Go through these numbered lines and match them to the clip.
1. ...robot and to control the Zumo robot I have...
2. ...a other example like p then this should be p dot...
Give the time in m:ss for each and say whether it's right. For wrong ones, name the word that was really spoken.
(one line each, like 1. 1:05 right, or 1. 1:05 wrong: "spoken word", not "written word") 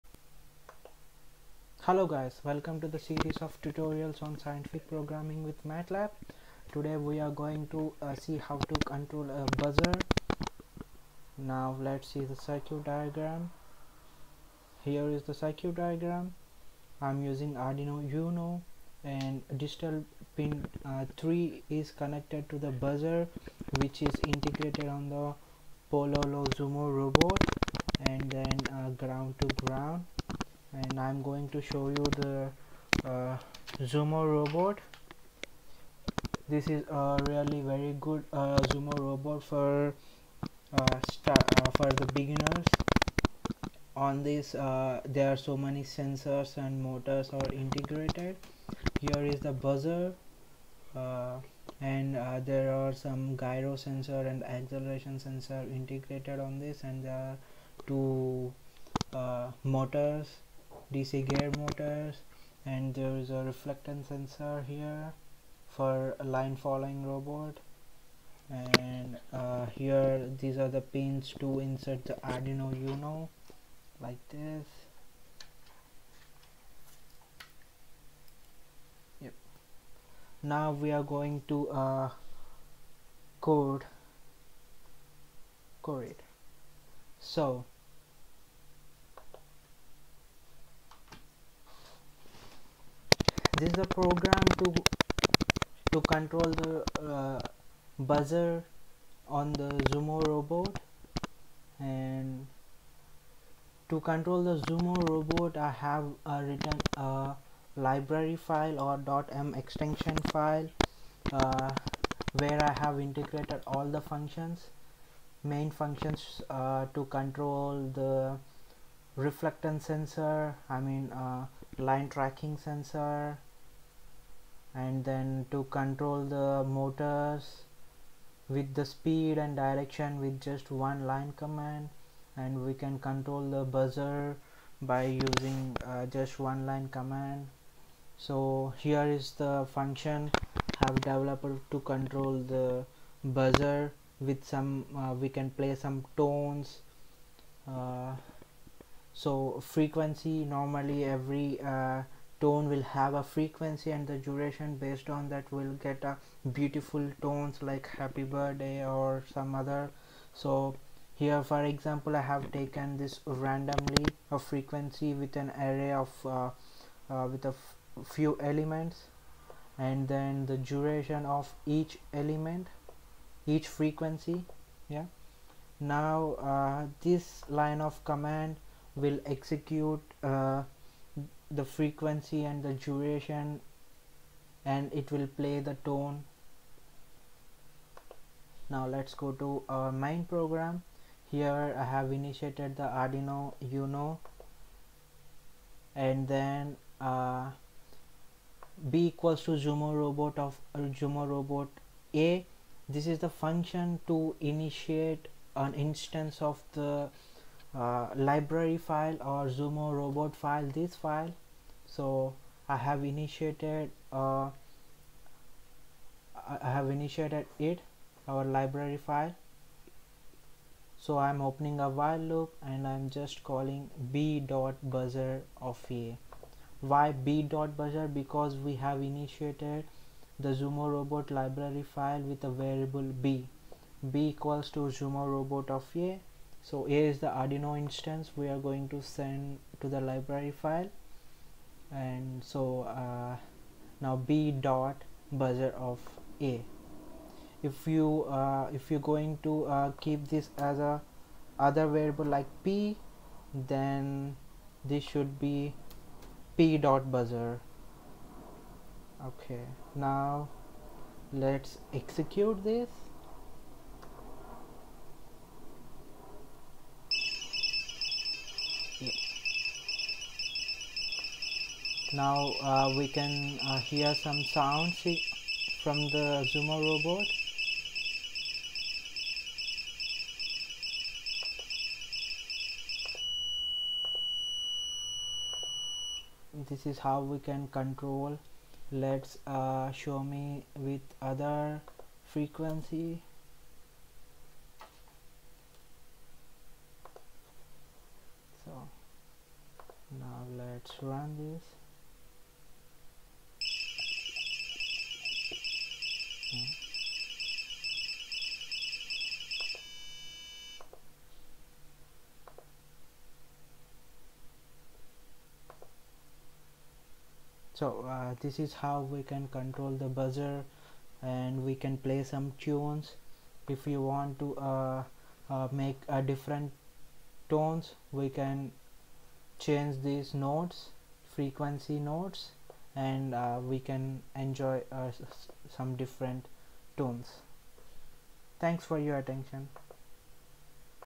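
1. 1:40 right
2. 4:10 wrong: "variable", not "example".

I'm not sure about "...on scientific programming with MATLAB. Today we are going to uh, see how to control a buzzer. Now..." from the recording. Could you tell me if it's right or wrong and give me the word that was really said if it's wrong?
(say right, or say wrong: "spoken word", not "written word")
right.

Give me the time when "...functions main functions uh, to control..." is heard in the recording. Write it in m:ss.
1:54.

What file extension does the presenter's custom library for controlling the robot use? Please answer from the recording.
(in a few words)
.m.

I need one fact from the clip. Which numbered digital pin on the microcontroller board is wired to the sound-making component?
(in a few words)
3.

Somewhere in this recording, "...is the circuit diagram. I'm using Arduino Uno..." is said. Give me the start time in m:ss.
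0:15.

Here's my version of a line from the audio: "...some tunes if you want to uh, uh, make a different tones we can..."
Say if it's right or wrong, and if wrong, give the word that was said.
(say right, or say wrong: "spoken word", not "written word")
right.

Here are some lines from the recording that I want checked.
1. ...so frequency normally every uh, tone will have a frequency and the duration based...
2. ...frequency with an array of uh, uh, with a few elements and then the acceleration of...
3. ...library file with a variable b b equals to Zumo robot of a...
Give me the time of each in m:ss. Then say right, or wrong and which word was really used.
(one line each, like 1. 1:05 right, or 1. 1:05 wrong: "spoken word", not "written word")
1. 2:29 right
2. 2:44 wrong: "duration", not "acceleration"
3. 3:51 right.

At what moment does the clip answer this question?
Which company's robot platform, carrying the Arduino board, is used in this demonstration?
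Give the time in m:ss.
0:25.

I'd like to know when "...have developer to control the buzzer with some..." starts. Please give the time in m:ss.
2:20.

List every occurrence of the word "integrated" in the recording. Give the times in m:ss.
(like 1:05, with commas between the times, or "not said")
0:24, 0:47, 0:55, 1:53.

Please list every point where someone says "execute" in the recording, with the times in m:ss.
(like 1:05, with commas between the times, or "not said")
2:59, 4:21.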